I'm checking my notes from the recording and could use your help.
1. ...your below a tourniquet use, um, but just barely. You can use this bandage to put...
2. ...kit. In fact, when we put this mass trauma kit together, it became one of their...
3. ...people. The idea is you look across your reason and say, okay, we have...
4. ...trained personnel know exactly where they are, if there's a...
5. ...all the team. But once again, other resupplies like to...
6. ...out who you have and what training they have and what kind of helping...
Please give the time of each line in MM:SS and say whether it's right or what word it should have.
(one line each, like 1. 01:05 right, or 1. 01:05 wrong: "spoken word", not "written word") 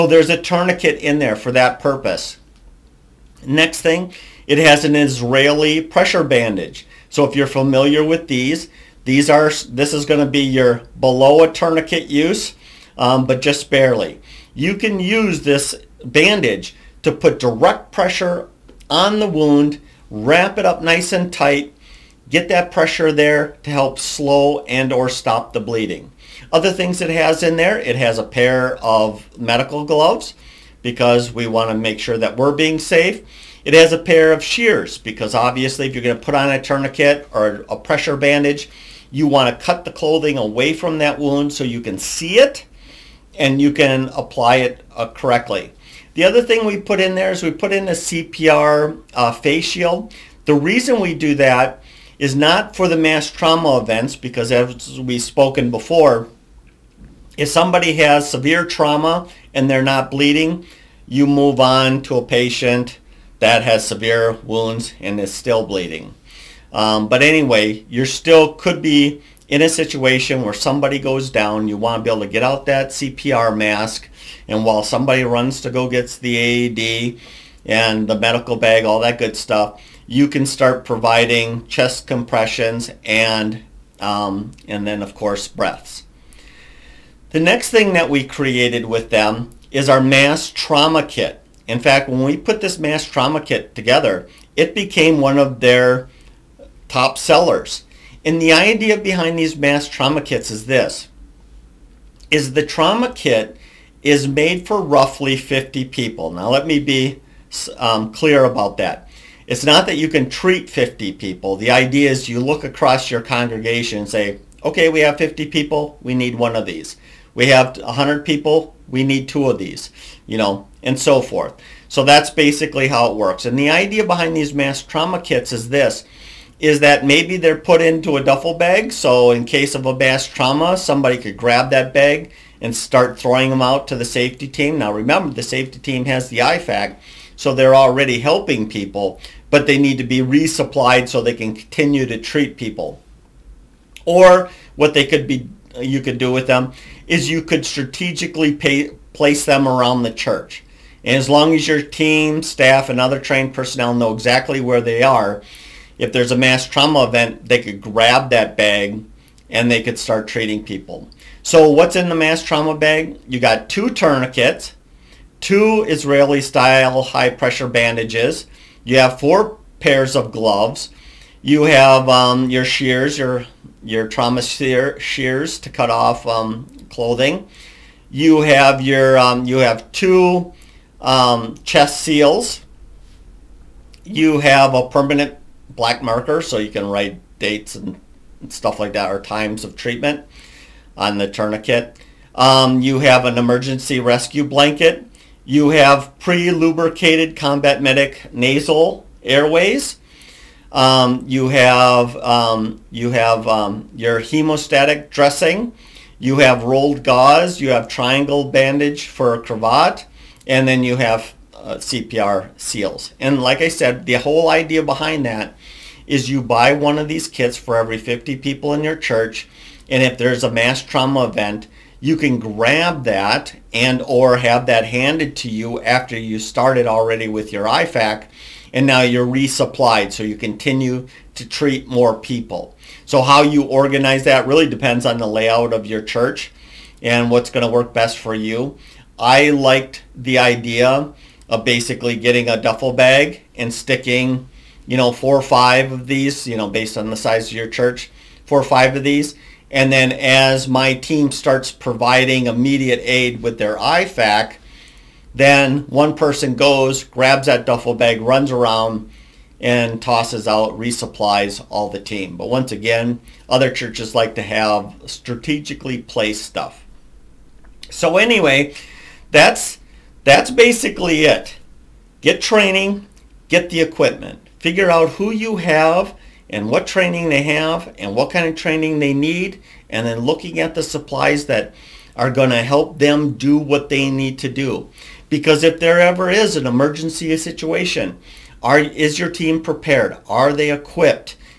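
1. 00:10 right
2. 01:31 right
3. 01:51 wrong: "congregation", not "reason"
4. 02:33 right
5. 04:21 wrong: "churches", not "resupplies"
6. 04:34 wrong: "training", not "helping".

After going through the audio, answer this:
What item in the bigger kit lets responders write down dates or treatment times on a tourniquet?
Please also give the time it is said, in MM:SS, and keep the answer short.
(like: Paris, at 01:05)
permanent black marker, at 03:04.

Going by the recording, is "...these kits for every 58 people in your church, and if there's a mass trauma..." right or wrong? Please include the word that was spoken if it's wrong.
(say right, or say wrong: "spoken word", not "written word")
wrong: "50", not "58".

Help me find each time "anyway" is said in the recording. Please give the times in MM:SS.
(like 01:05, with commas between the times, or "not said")
01:07, 04:28.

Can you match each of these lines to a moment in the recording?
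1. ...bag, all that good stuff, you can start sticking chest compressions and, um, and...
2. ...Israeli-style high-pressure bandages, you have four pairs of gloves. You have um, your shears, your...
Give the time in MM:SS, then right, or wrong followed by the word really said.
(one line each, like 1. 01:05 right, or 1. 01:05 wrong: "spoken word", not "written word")
1. 01:18 wrong: "providing", not "sticking"
2. 02:45 right.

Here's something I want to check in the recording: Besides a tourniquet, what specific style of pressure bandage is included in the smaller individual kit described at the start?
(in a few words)
Israeli pressure bandage.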